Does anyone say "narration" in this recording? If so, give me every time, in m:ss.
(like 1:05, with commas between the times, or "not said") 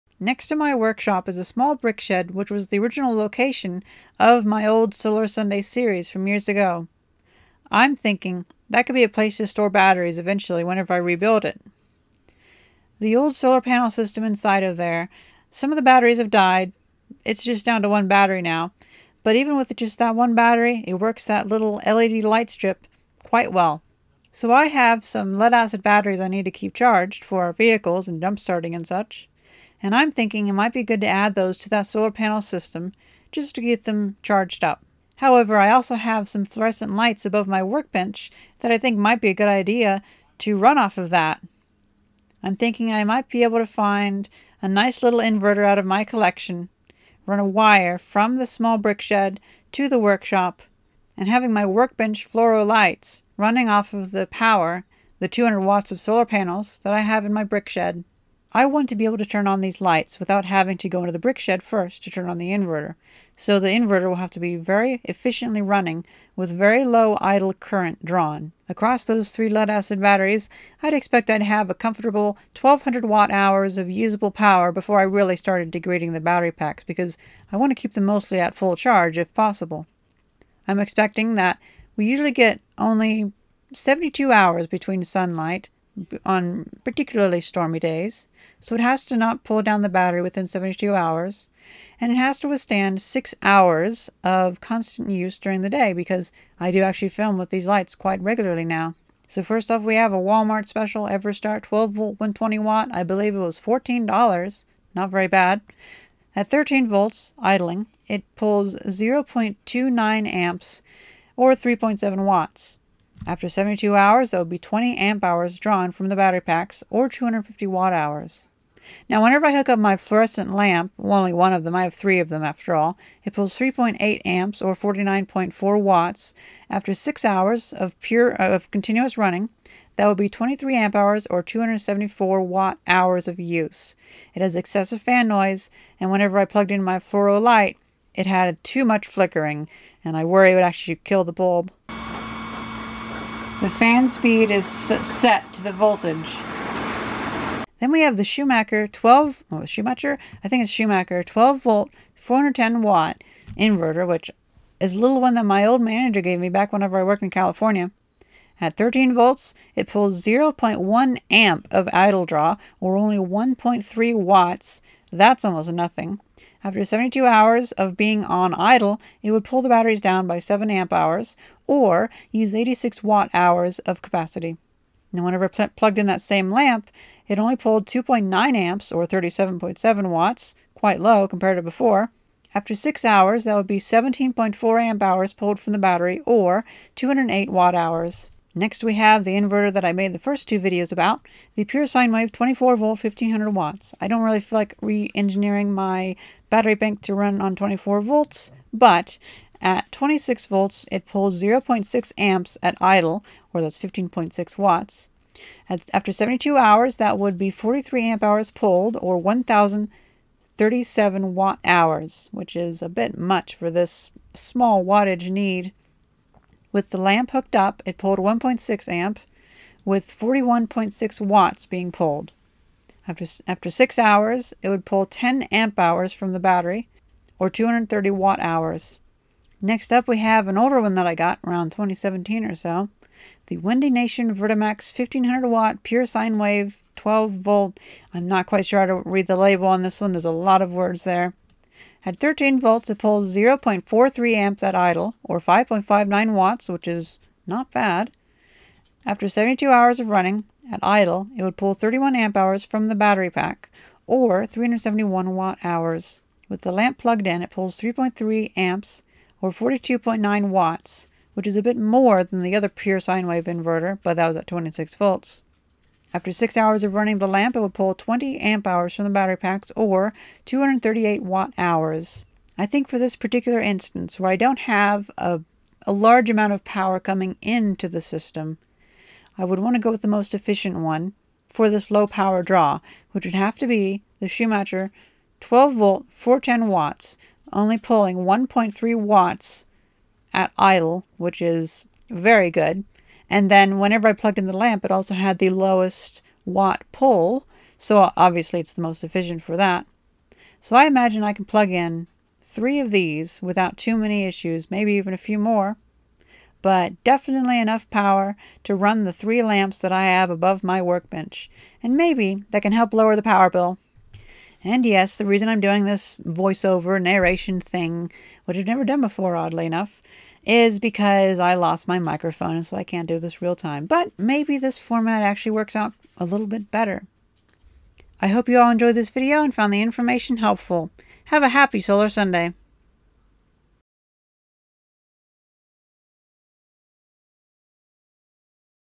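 5:17.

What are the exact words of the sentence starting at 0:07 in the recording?
I'm thinking that could be a place to store batteries eventually whenever I rebuild it.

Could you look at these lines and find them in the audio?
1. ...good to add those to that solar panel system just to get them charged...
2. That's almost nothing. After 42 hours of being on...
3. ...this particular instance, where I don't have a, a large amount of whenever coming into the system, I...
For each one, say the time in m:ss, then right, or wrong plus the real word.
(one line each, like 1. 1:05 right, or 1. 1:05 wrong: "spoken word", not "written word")
1. 0:30 right
2. 2:45 wrong: "72", not "42"
3. 4:32 wrong: "power", not "whenever".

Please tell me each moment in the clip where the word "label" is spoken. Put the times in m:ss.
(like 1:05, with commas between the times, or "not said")
3:59.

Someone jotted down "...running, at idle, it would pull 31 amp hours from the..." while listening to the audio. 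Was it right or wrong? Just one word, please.
right.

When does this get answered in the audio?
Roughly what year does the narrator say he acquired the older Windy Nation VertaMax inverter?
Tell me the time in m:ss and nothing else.
3:51.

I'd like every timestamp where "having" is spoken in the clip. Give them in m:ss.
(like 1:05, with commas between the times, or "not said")
0:51, 1:00.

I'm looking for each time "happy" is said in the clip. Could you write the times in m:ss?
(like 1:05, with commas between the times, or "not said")
5:31.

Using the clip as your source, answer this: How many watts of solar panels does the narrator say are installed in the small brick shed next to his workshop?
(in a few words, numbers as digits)
200.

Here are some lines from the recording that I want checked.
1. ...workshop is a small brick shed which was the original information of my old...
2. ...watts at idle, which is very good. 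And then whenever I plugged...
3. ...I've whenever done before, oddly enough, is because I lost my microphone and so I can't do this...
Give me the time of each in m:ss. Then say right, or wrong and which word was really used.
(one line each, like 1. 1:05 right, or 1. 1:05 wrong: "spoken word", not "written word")
1. 0:00 wrong: "location", not "information"
2. 4:48 right
3. 5:18 wrong: "never", not "whenever".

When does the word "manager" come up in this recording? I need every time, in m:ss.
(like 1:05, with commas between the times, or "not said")
2:35.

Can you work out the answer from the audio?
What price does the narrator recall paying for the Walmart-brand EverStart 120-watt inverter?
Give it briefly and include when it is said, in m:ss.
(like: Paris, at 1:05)
$14, at 1:43.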